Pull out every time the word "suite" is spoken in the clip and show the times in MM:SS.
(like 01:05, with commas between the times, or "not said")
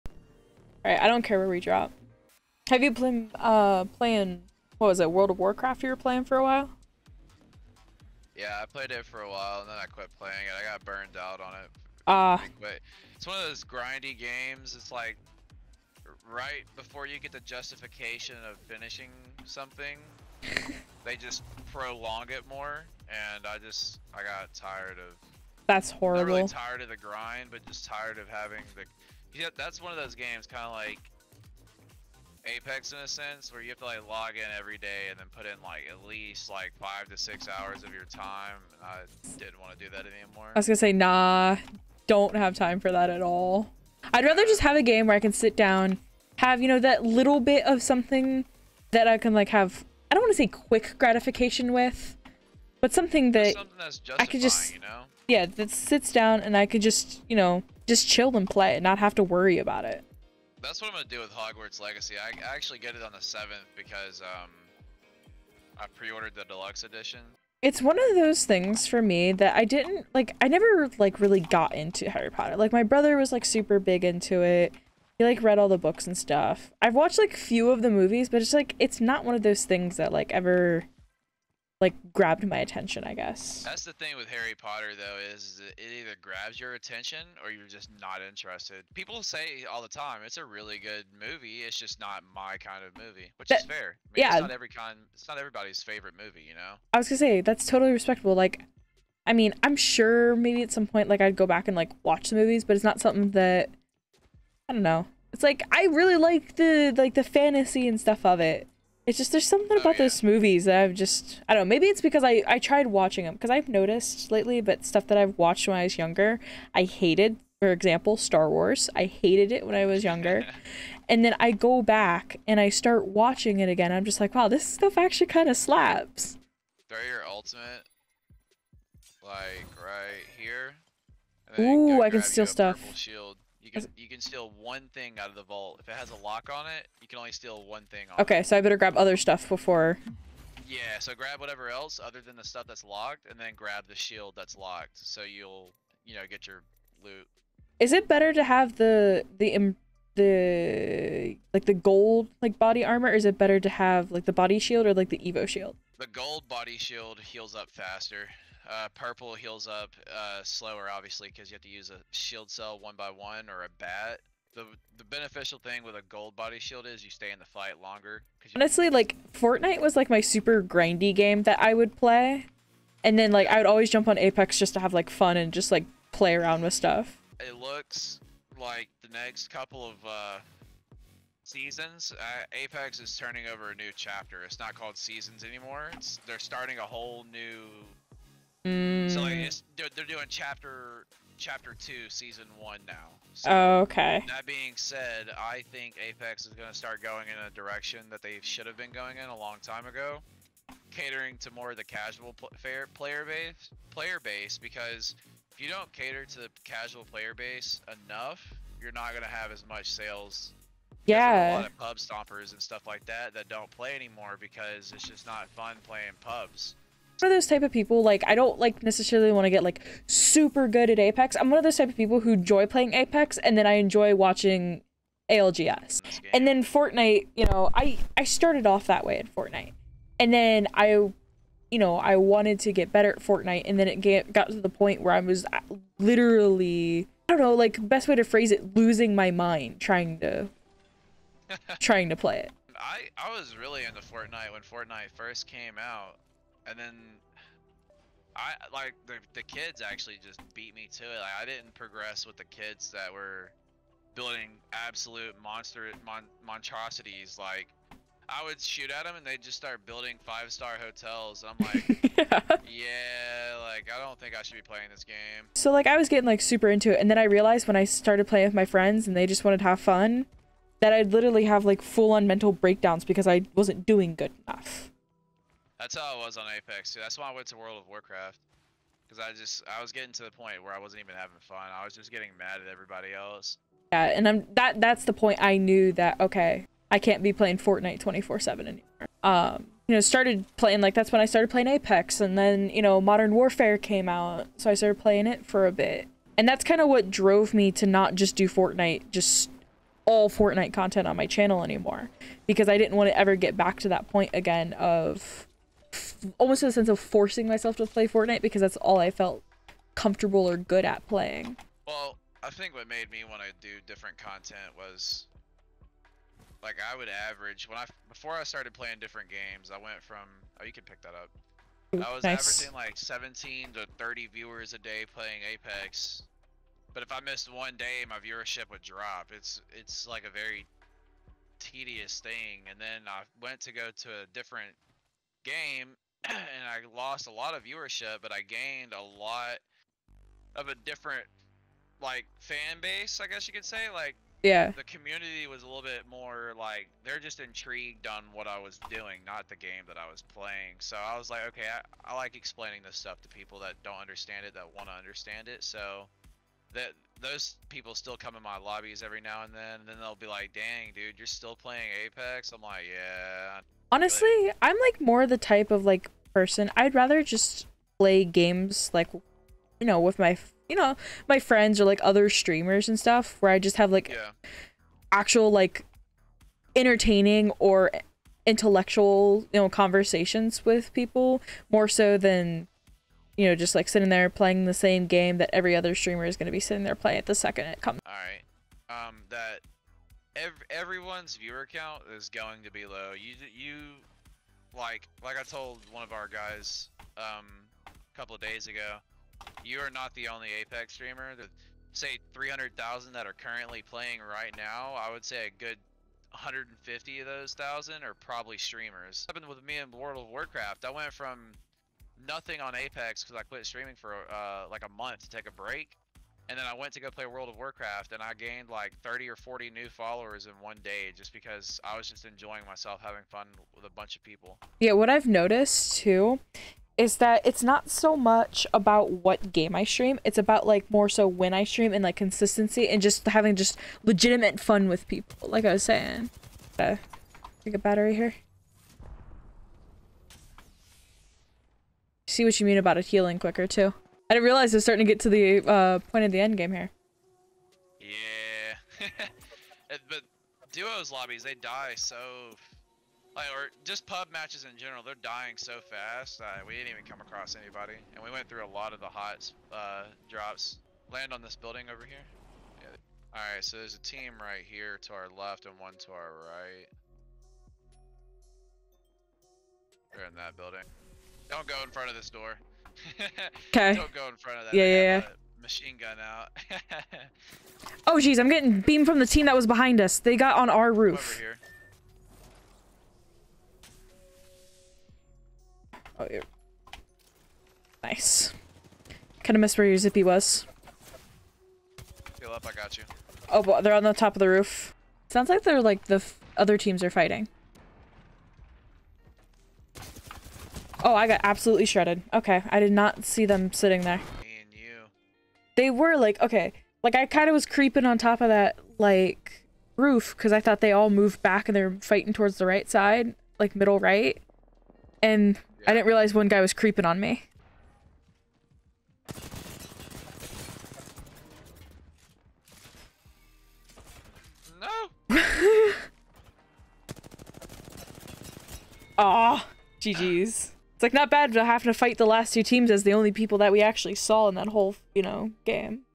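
not said.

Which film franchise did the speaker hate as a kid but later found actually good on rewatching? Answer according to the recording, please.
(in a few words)
Star Wars.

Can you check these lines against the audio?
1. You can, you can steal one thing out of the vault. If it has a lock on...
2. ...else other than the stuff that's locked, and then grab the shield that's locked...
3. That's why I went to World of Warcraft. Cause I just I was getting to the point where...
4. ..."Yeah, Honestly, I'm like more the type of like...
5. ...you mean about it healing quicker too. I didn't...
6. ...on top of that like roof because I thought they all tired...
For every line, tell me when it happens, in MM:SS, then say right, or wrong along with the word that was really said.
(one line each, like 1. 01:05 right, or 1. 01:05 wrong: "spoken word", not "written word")
1. 02:13 right
2. 02:21 right
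3. 04:36 right
4. 06:02 right
5. 07:22 right
6. 08:28 wrong: "moved", not "tired".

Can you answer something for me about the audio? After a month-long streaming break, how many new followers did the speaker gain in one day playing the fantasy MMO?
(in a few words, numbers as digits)
30 or 40.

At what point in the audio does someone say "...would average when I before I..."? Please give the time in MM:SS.
05:16.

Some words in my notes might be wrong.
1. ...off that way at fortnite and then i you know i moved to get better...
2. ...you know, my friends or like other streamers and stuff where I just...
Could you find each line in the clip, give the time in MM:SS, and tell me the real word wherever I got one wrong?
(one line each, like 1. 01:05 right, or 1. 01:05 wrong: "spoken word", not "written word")
1. 03:48 wrong: "wanted", not "moved"
2. 06:10 right.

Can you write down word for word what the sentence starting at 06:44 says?
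I would say a good 150 of those thousand are probably streamers.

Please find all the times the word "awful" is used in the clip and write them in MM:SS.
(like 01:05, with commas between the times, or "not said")
not said.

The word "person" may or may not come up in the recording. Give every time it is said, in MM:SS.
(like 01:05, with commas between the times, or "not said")
06:06.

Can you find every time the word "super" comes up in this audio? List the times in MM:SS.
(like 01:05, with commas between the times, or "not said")
01:13, 02:50, 03:40, 04:26.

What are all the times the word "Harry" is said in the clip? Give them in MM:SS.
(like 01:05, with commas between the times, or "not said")
01:12, 01:24.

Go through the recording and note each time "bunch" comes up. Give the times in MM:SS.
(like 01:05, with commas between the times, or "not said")
07:03.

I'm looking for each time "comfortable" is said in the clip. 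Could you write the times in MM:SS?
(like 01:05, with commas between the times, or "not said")
05:09.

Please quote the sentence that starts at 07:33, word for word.
Like, or just pub matches in general, they're dying so fast.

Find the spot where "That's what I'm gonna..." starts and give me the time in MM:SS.
01:00.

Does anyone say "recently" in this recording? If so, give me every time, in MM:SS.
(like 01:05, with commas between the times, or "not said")
not said.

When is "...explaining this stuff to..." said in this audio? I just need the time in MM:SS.
05:52.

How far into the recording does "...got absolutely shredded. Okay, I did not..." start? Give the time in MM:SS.
08:21.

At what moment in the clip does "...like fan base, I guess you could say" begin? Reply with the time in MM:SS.
05:42.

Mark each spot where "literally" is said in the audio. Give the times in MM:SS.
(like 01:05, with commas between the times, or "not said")
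03:55, 04:31.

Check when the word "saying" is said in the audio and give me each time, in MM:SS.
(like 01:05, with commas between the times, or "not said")
07:15.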